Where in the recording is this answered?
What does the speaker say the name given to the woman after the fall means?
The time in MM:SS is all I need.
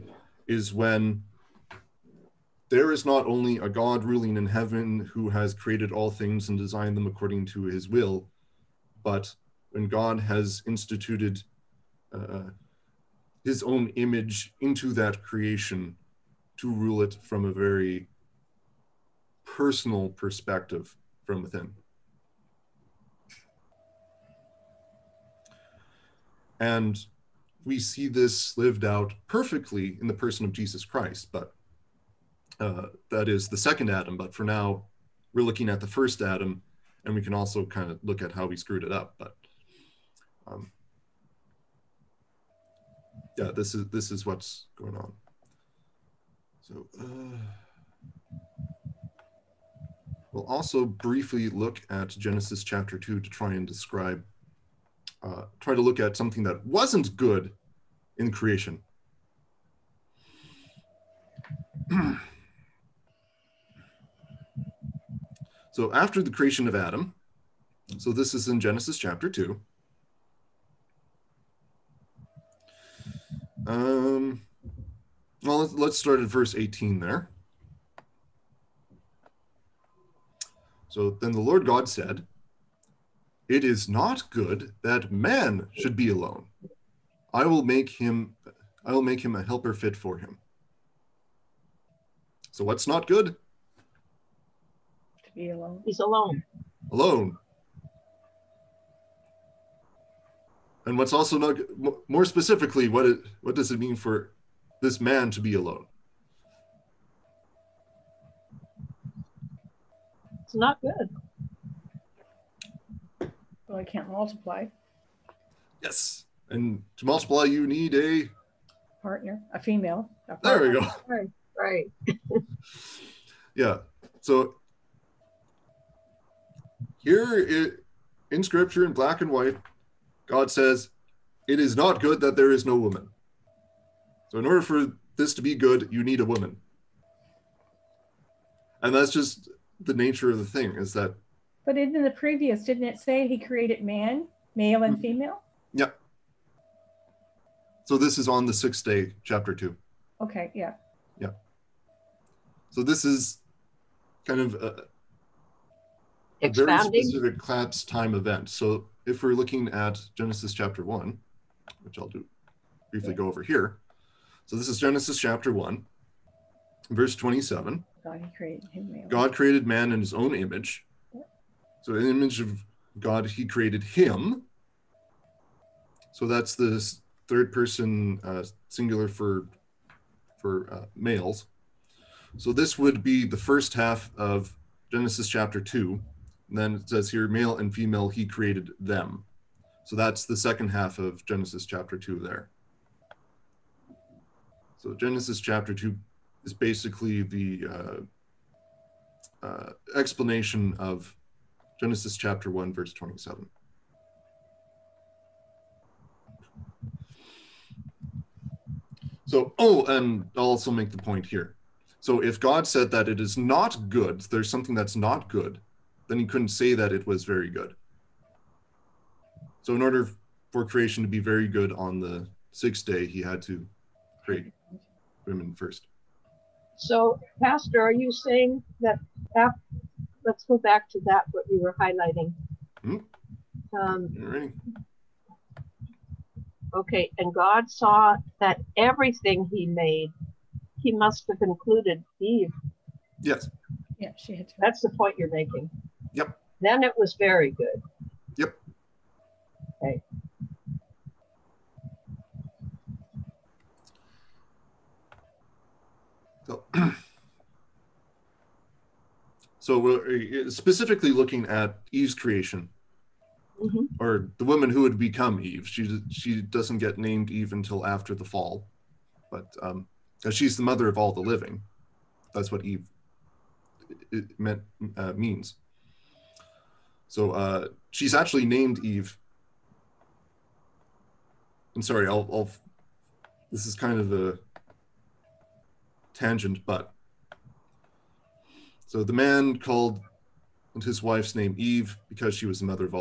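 04:30.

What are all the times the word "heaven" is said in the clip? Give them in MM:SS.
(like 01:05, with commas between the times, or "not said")
00:04.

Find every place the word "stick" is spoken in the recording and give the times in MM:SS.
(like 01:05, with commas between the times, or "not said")
not said.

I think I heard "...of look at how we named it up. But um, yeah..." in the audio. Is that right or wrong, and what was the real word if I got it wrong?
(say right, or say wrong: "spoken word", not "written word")
wrong: "screwed", not "named".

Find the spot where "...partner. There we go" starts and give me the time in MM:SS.
02:00.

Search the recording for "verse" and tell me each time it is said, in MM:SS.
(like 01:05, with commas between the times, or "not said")
01:16, 02:46, 03:22.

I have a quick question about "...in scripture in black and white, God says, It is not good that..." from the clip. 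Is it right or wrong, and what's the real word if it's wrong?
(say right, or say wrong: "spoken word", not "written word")
right.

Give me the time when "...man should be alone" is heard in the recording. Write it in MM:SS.
01:25.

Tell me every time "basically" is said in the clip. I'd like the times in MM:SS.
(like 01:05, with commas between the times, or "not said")
03:16.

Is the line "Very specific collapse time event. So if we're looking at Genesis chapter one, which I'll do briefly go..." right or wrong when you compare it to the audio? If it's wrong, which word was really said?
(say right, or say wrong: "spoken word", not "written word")
right.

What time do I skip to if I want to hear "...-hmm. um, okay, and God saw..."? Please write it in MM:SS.
03:53.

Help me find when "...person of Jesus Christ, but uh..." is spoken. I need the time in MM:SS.
00:30.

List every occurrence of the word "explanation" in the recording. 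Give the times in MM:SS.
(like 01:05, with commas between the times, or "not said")
03:19.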